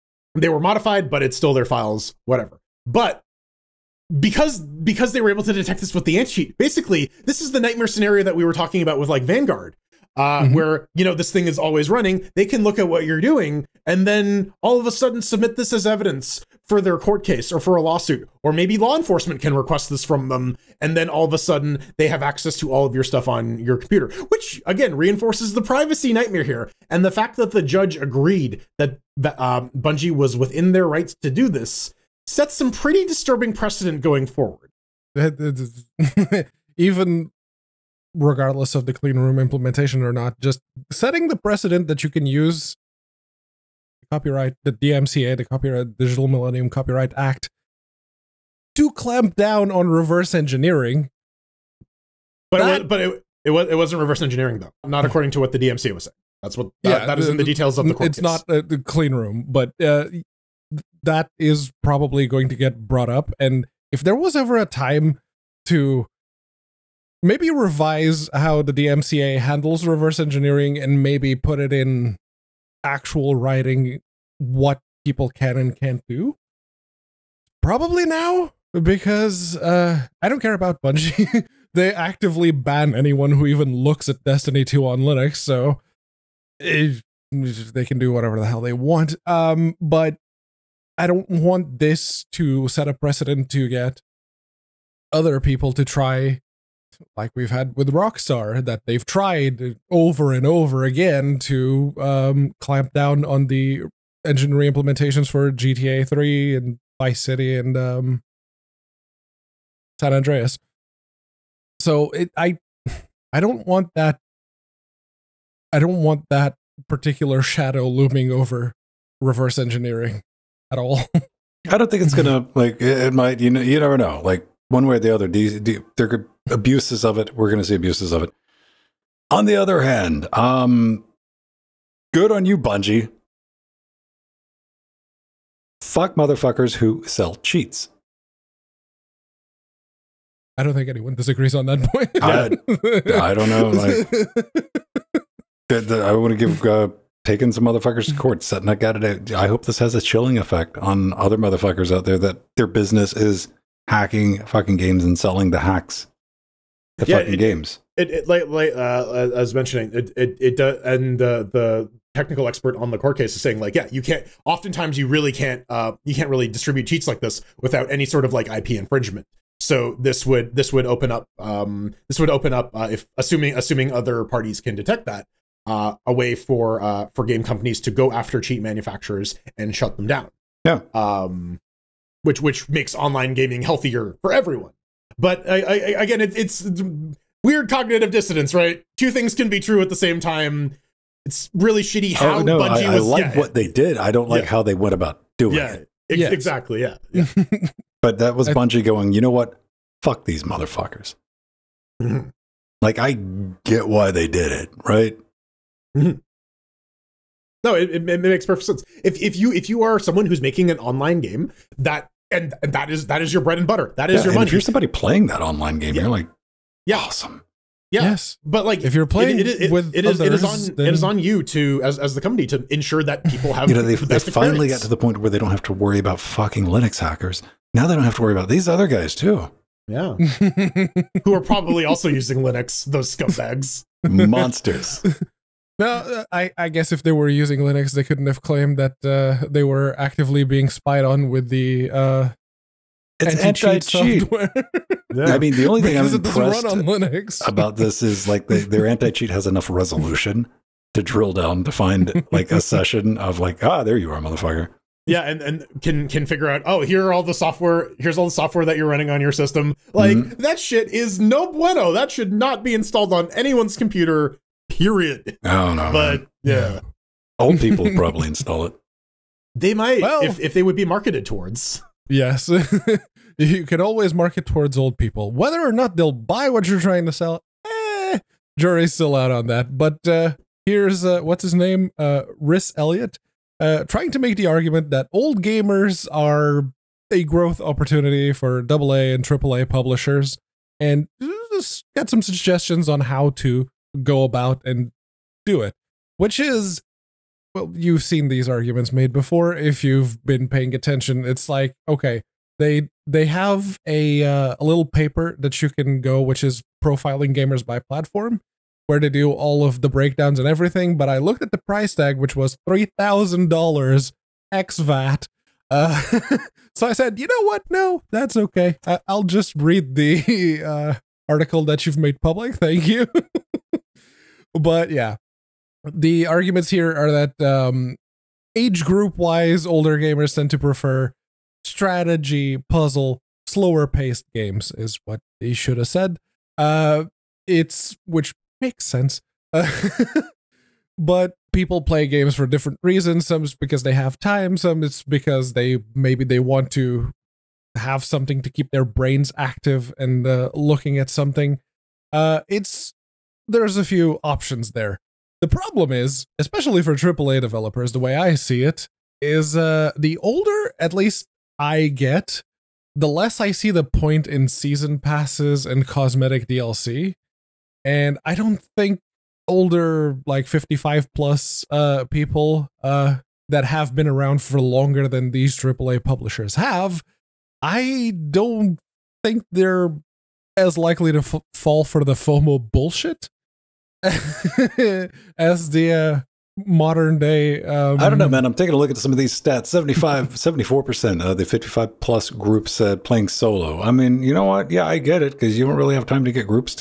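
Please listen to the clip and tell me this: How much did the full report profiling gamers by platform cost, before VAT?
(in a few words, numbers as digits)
$3,000.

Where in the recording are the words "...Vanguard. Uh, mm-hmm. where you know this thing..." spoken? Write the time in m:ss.
0:09.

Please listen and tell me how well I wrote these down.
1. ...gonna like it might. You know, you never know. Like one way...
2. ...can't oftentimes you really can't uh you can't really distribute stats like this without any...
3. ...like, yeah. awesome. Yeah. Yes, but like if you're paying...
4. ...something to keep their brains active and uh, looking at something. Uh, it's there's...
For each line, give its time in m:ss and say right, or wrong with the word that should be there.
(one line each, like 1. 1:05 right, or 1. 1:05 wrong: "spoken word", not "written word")
1. 2:02 right
2. 2:44 wrong: "cheats", not "stats"
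3. 3:36 wrong: "playing", not "paying"
4. 5:48 right.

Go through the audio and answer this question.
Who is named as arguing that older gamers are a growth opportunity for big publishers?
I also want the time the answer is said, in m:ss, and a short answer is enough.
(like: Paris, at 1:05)
Rhys Elliott, at 4:42.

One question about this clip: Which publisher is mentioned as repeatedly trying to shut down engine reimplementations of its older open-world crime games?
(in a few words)
Rockstar.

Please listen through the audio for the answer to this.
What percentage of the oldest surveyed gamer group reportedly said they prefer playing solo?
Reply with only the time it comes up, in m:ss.
6:30.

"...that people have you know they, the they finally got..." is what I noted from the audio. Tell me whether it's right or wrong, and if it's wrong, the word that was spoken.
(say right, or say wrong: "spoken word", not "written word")
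right.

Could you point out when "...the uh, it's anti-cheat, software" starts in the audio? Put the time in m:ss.
4:01.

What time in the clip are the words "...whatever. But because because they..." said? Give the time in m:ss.
0:02.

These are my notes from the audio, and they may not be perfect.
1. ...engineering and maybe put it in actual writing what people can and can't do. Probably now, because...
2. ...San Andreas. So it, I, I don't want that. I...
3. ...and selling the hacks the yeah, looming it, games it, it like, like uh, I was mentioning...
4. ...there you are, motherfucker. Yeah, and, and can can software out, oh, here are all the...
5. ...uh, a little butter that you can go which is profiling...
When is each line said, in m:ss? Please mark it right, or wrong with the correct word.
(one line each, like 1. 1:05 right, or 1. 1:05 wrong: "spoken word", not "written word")
1. 1:10 right
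2. 1:49 right
3. 2:35 wrong: "fucking", not "looming"
4. 4:13 wrong: "figure", not "software"
5. 5:04 wrong: "paper", not "butter".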